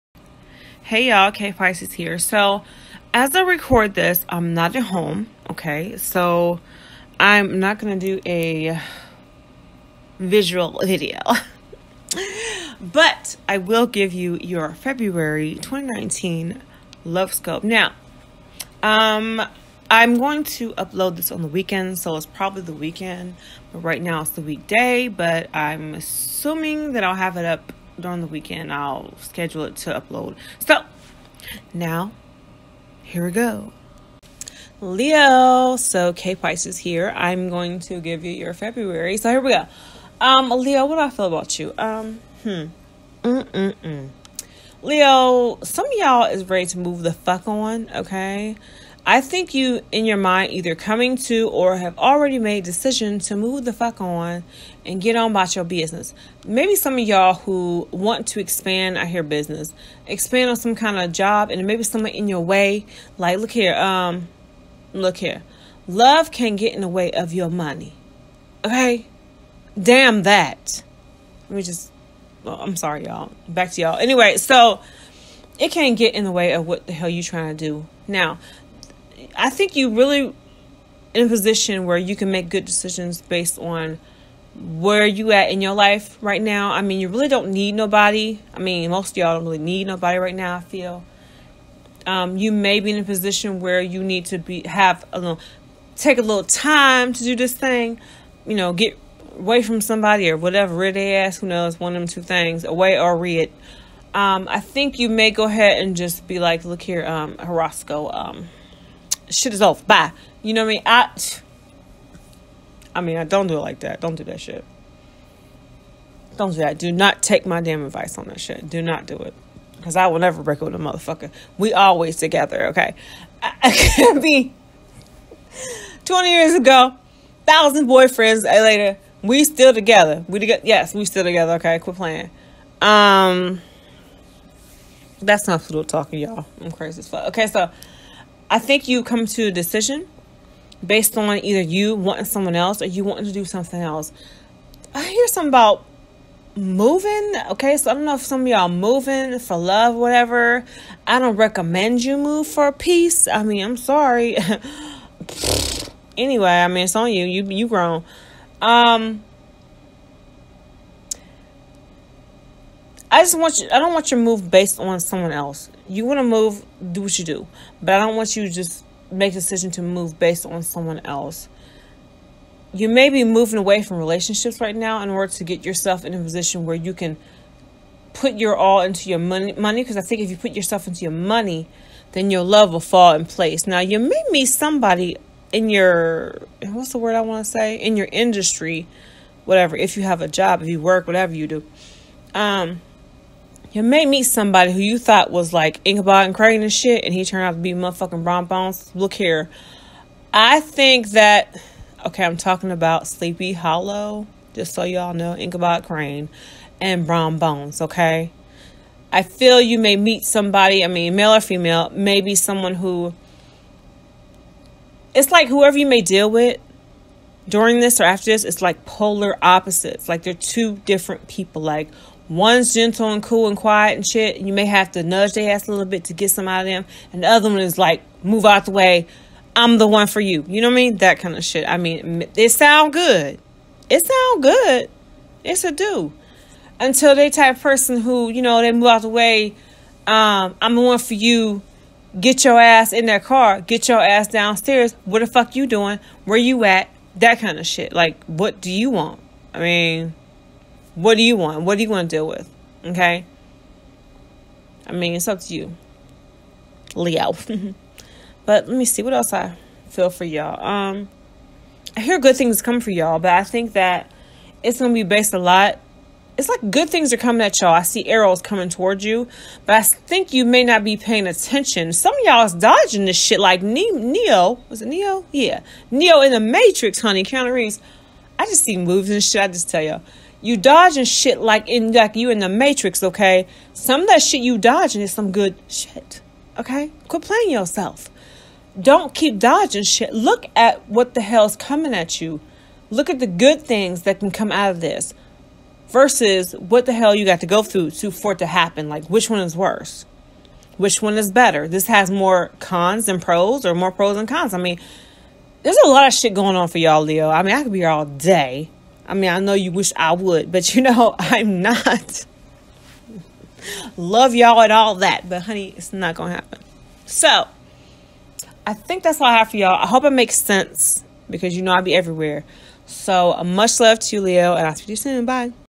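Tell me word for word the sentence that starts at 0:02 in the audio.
So, as I record this, I'm not at home, okay?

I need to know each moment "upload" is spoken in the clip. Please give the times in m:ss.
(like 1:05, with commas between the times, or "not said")
0:20, 0:29.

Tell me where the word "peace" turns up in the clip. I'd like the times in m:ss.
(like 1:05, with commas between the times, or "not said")
2:32.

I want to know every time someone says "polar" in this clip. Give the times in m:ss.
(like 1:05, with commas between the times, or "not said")
3:38.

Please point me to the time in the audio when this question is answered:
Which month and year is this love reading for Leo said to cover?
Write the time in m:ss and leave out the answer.
0:14.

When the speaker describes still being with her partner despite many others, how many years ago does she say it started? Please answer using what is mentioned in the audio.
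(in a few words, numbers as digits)
20 years.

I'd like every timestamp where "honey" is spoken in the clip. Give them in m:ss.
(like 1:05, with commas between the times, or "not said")
4:36, 5:15.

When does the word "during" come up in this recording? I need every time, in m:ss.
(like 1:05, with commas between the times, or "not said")
0:27, 3:37.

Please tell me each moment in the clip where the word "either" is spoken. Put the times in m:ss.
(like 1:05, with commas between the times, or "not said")
0:50, 2:21.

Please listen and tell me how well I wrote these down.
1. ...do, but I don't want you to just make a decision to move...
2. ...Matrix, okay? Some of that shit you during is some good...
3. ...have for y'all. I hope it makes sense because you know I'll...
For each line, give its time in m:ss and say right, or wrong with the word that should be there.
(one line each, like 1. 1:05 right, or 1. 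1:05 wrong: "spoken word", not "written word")
1. 2:47 right
2. 4:42 wrong: "dodging", not "during"
3. 5:19 right.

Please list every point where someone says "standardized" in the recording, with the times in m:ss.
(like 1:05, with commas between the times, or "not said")
not said.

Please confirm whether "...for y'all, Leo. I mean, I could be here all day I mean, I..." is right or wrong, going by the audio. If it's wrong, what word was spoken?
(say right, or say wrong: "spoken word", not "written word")
right.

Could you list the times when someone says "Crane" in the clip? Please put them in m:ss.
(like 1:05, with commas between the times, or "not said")
3:16, 3:25.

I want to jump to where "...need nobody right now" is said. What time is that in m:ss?
1:29.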